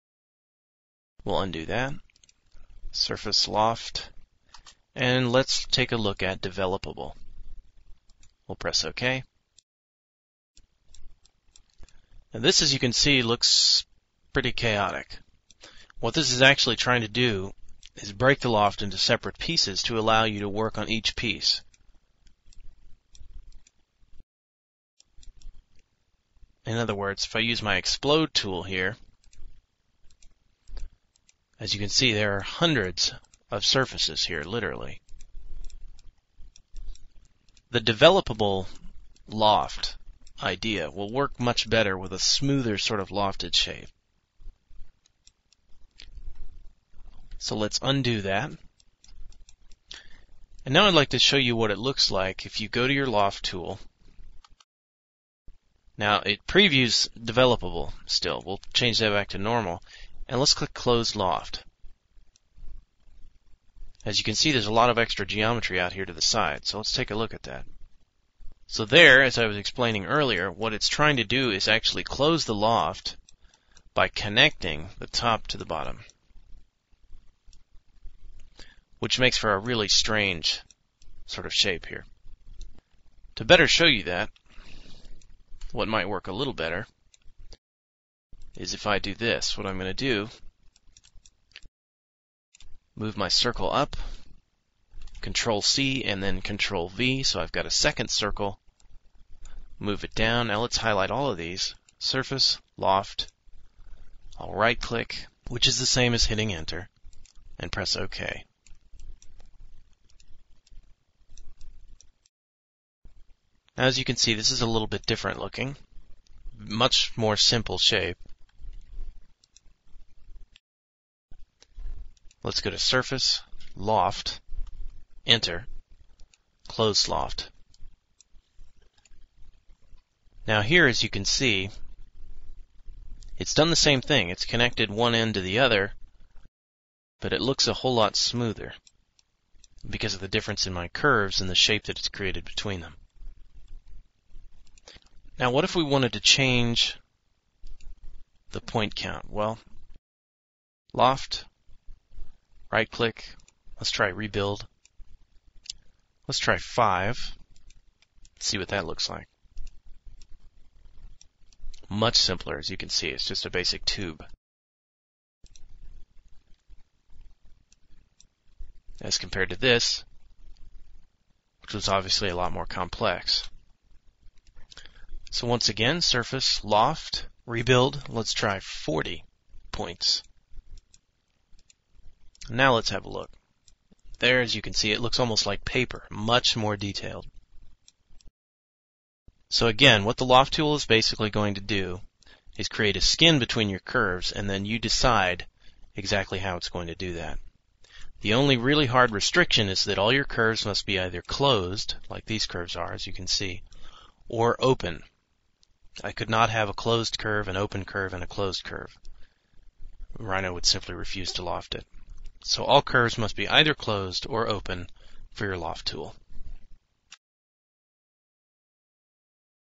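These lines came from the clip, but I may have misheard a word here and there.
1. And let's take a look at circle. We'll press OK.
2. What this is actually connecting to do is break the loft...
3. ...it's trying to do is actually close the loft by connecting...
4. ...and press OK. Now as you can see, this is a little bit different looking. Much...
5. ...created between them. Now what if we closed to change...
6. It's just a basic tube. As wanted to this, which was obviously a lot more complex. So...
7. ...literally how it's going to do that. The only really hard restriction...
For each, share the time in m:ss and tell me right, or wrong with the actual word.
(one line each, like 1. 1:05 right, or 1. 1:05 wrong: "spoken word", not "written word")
1. 0:04 wrong: "developable", not "circle"
2. 0:15 wrong: "trying", not "connecting"
3. 1:10 right
4. 1:47 right
5. 2:22 wrong: "wanted", not "closed"
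6. 2:43 wrong: "compared", not "wanted"
7. 3:15 wrong: "exactly", not "literally".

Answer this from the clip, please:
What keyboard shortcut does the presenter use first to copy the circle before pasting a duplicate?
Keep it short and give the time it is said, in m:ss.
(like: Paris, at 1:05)
Control C, at 1:35.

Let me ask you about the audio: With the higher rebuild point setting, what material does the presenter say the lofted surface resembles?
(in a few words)
paper.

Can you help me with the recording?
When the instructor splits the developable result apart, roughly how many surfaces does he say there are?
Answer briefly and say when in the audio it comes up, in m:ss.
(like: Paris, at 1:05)
hundreds, at 0:32.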